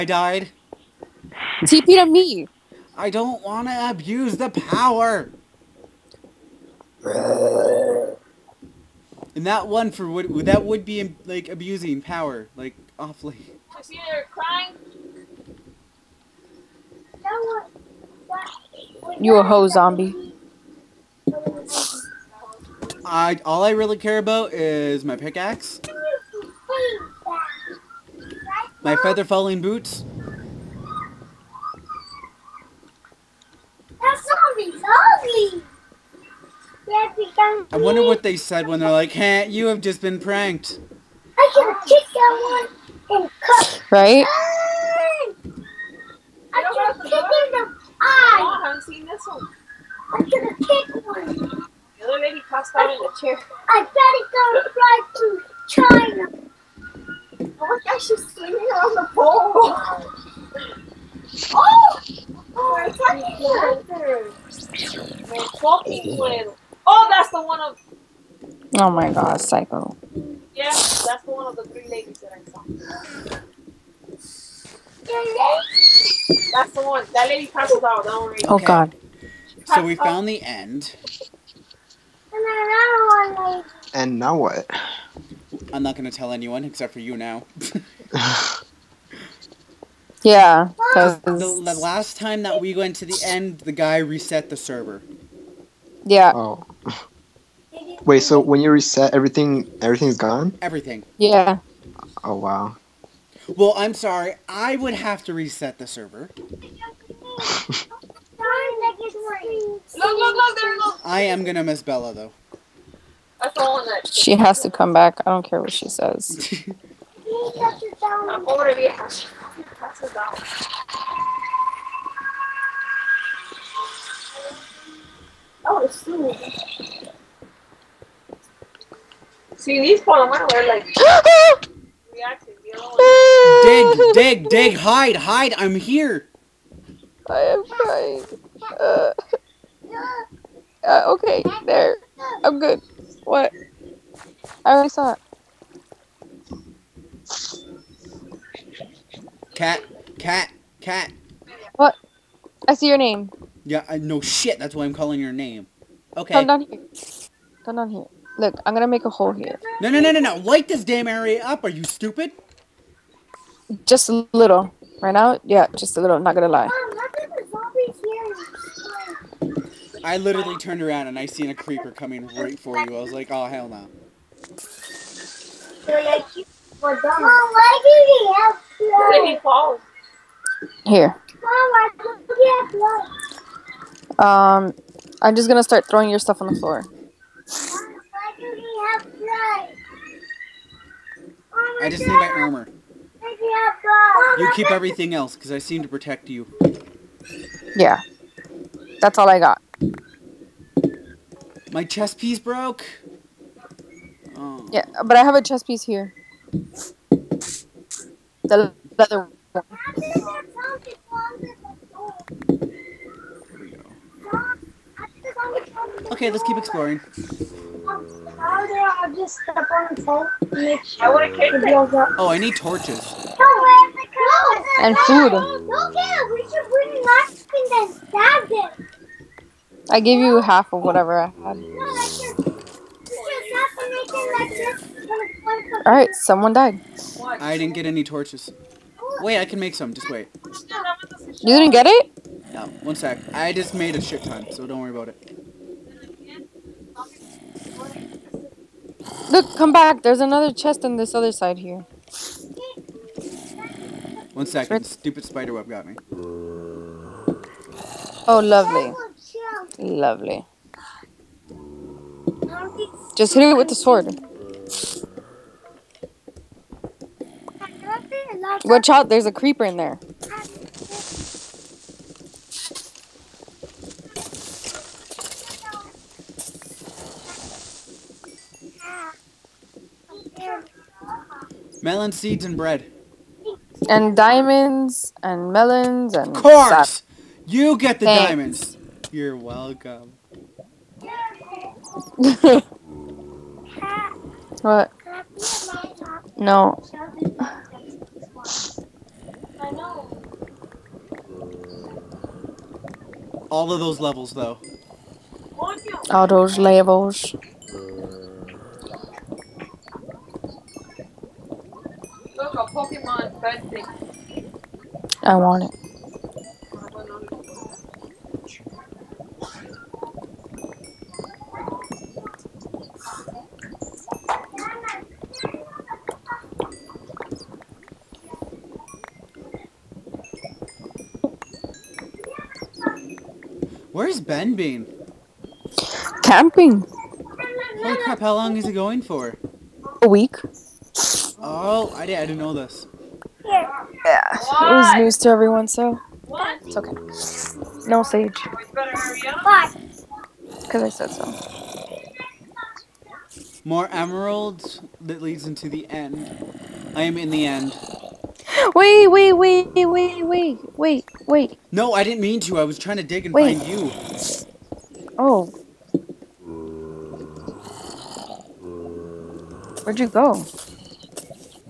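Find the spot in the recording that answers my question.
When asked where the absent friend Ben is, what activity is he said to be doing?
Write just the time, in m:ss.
5:36.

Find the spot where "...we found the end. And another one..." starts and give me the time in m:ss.
1:19.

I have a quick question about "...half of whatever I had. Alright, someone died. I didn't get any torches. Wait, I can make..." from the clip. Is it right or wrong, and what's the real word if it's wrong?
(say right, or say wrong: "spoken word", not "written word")
right.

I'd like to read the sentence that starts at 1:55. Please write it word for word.
I don't care what she says.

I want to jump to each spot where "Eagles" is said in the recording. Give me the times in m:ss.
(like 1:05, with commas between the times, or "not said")
not said.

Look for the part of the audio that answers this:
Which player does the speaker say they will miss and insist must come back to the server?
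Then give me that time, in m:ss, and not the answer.
1:51.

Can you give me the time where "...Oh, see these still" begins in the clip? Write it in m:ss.
2:05.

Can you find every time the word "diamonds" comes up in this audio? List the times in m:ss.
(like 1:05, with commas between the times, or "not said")
4:44, 4:48.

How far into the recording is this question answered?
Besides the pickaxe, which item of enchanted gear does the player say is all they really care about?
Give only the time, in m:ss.
0:28.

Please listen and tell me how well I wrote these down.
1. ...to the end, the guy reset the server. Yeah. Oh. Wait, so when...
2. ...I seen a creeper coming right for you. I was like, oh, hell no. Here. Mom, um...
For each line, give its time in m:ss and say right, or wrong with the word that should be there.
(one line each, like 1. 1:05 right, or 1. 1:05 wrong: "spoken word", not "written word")
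1. 1:32 right
2. 2:51 right.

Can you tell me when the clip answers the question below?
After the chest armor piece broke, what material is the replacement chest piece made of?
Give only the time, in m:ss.
3:28.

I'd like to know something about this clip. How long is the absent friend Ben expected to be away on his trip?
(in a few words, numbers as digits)
A week.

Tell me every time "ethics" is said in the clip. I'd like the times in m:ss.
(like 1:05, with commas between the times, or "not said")
not said.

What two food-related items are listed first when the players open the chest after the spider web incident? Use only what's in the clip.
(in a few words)
Melon seeds and bread.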